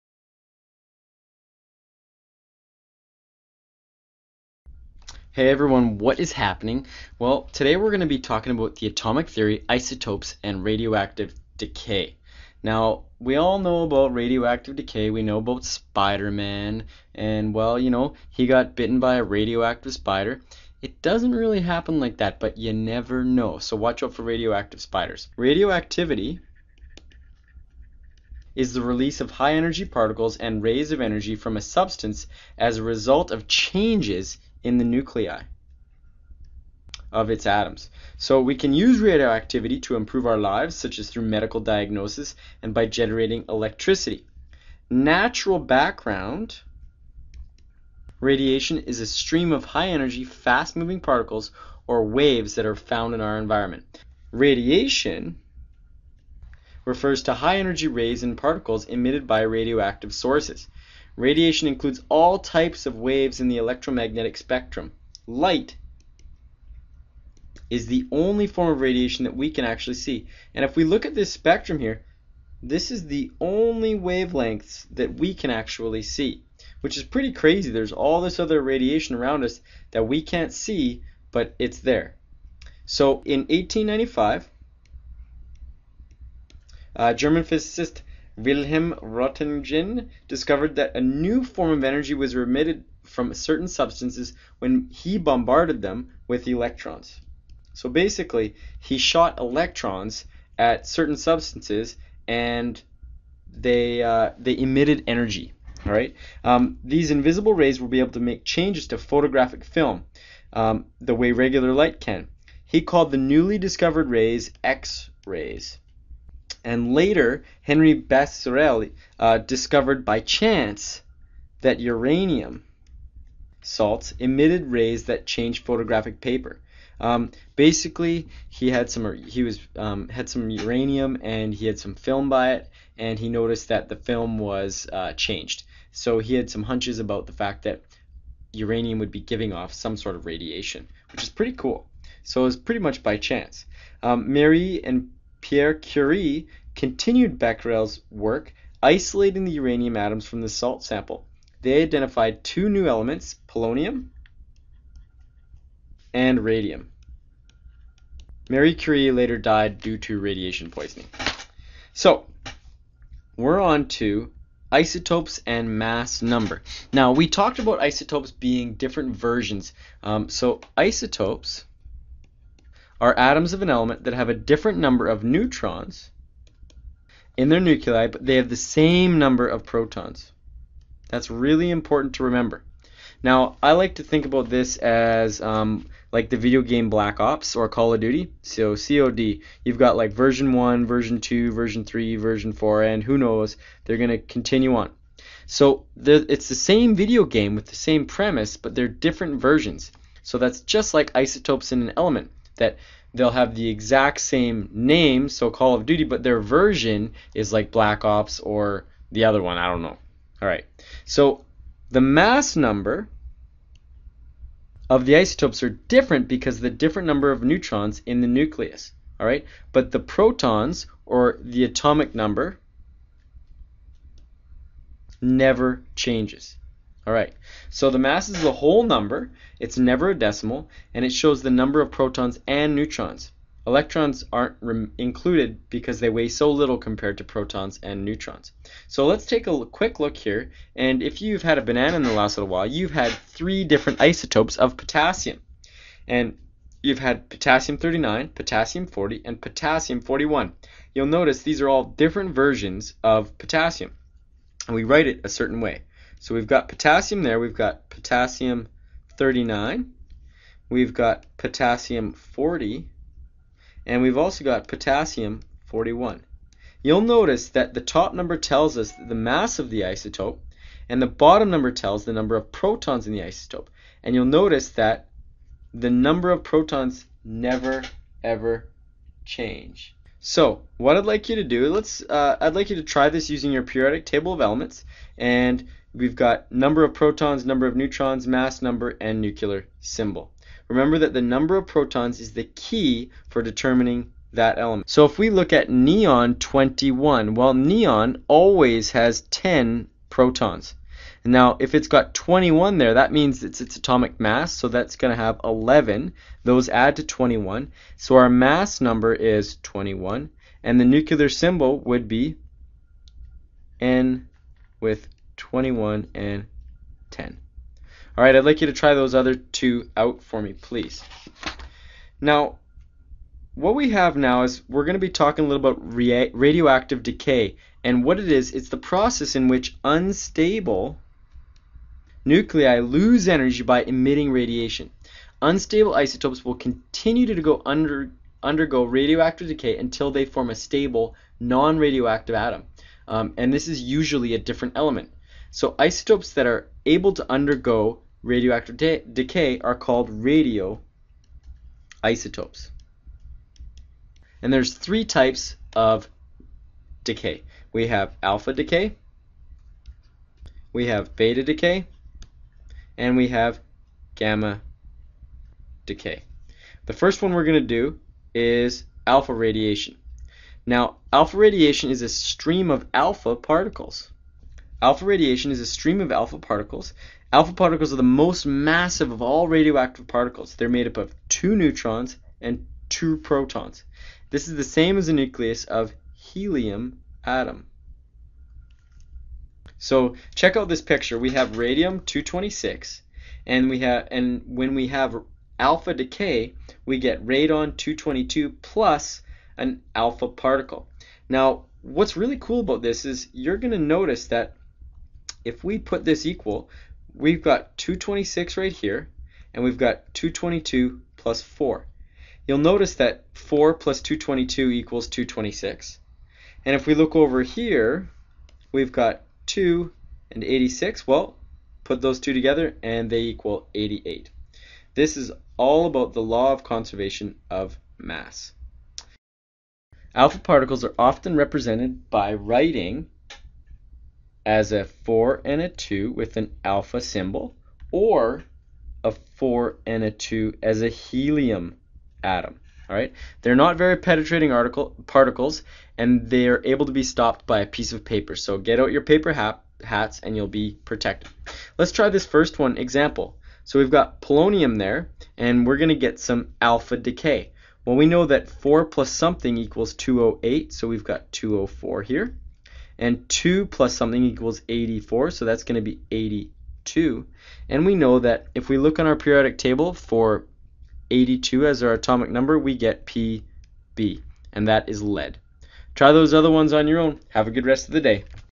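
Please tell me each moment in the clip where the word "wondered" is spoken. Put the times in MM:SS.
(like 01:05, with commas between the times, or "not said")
not said.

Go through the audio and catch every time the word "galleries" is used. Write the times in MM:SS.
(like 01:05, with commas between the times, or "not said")
not said.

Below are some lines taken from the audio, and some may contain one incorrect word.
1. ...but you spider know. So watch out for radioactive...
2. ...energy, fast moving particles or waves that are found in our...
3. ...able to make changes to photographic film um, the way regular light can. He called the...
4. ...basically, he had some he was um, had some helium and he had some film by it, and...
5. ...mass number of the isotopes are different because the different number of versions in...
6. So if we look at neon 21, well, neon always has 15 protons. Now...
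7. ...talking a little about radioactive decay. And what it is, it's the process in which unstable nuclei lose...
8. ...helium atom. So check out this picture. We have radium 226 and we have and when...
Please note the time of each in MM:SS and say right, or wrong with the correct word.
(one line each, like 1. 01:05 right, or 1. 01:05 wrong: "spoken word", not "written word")
1. 00:22 wrong: "never", not "spider"
2. 00:49 right
3. 01:47 right
4. 02:07 wrong: "uranium", not "helium"
5. 03:32 wrong: "neutrons", not "versions"
6. 04:54 wrong: "10", not "15"
7. 05:25 right
8. 06:26 right.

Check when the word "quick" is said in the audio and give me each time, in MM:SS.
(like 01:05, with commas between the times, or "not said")
03:59.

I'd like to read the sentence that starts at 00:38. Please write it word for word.
So we can use radioactivity to improve our lives, such as through medical diagnosis and by generating electricity.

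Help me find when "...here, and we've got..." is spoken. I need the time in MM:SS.
06:48.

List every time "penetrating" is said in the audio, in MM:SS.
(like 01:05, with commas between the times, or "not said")
07:23.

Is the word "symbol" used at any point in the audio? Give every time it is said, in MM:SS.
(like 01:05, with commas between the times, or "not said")
04:49, 05:11, 07:17.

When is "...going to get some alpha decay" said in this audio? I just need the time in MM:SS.
07:35.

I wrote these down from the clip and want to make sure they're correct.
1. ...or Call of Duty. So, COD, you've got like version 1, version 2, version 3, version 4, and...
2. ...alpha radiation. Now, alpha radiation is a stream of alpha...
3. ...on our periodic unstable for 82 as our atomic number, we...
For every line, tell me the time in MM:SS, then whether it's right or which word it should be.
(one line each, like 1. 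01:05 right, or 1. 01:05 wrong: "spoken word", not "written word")
1. 03:07 right
2. 06:09 right
3. 07:48 wrong: "table", not "unstable".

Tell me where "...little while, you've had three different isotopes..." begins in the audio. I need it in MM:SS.
04:02.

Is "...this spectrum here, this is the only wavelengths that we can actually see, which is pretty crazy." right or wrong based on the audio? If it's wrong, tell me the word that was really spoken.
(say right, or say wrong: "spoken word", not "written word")
right.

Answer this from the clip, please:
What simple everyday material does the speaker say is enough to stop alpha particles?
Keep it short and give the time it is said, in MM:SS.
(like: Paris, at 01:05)
a piece of paper, at 07:27.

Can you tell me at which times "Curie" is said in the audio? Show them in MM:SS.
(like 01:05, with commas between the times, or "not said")
02:25, 02:38.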